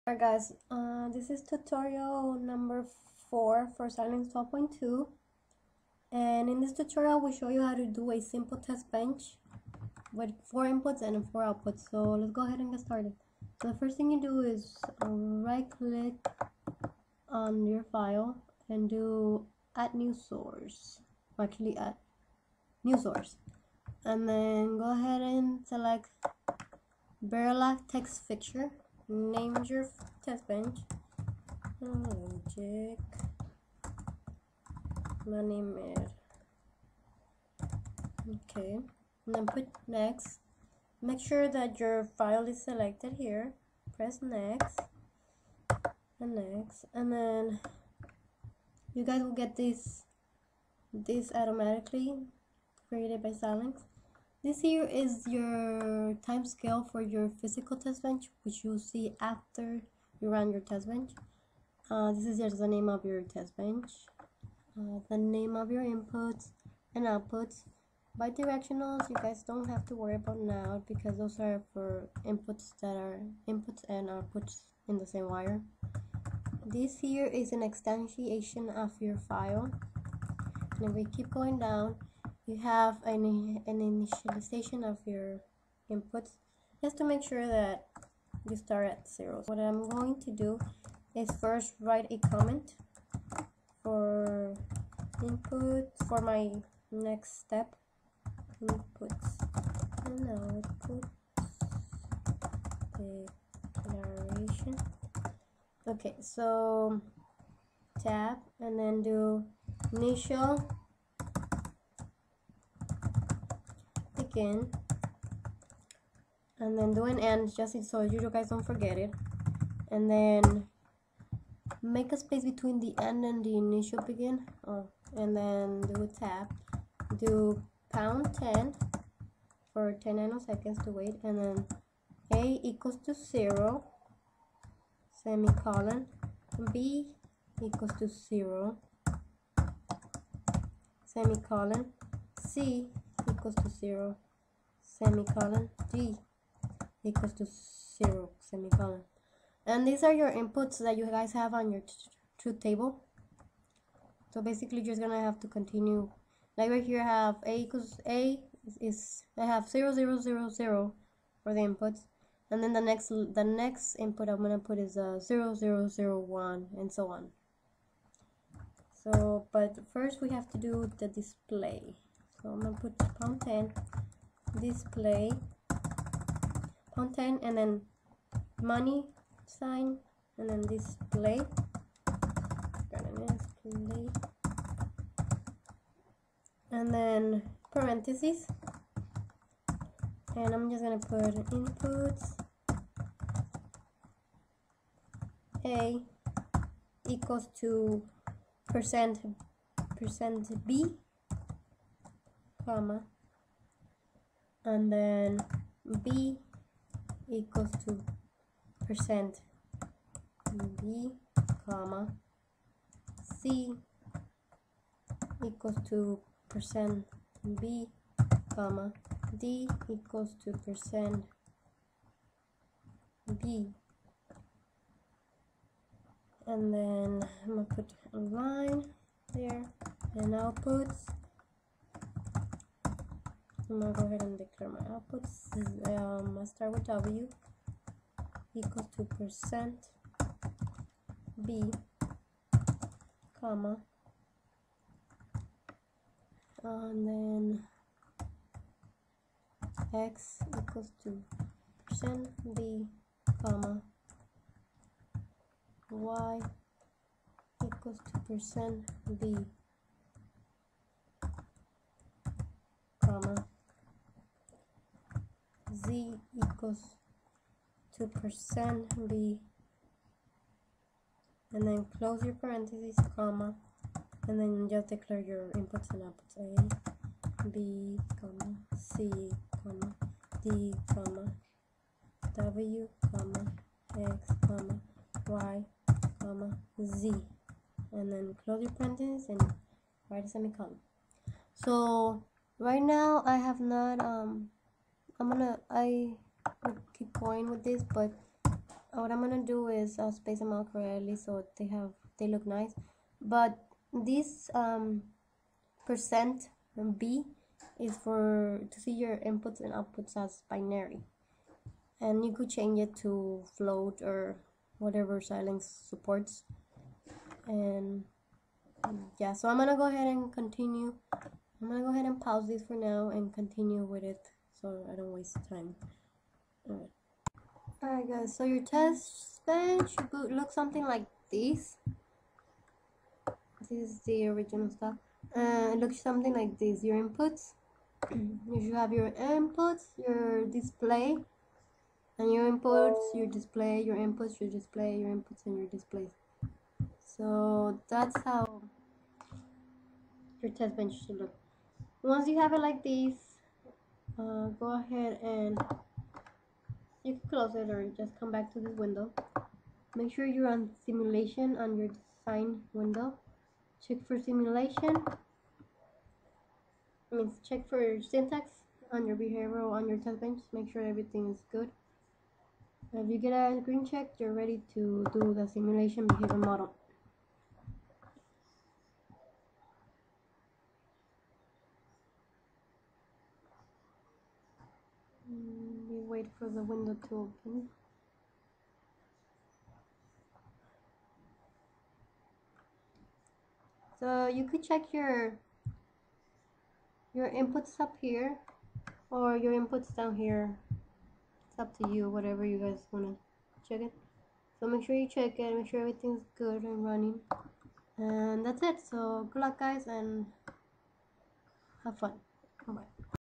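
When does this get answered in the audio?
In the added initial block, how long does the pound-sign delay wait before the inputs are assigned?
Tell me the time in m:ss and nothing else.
2:09.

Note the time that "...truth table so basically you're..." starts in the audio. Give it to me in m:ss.
2:32.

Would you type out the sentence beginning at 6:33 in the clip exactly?
So you could check your your inputs up here or your inputs down here.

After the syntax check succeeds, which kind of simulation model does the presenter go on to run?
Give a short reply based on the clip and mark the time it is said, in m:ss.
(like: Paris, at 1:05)
behavior model, at 6:16.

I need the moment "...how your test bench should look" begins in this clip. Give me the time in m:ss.
5:48.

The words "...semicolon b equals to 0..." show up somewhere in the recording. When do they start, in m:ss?
2:15.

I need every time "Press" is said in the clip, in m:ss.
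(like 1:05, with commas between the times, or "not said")
0:43.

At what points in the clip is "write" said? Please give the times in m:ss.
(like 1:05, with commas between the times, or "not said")
1:31, 4:50.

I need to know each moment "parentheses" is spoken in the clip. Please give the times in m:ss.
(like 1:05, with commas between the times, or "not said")
3:07, 4:32, 4:48.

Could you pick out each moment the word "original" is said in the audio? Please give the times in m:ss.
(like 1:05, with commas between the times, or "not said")
5:34.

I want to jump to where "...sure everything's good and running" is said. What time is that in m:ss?
6:45.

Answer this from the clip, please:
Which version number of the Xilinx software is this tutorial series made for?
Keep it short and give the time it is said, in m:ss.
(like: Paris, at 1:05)
12.2, at 0:04.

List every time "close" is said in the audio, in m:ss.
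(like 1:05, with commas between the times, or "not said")
4:31, 4:48, 5:57.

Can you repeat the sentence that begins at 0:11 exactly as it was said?
So let's go ahead and get started.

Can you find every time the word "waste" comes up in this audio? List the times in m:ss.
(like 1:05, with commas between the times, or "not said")
5:25.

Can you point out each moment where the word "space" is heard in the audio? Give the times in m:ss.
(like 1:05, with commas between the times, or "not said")
2:02, 5:00.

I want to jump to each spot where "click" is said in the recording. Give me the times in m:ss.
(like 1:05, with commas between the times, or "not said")
0:15.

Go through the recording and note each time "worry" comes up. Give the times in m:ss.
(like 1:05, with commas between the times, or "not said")
1:09.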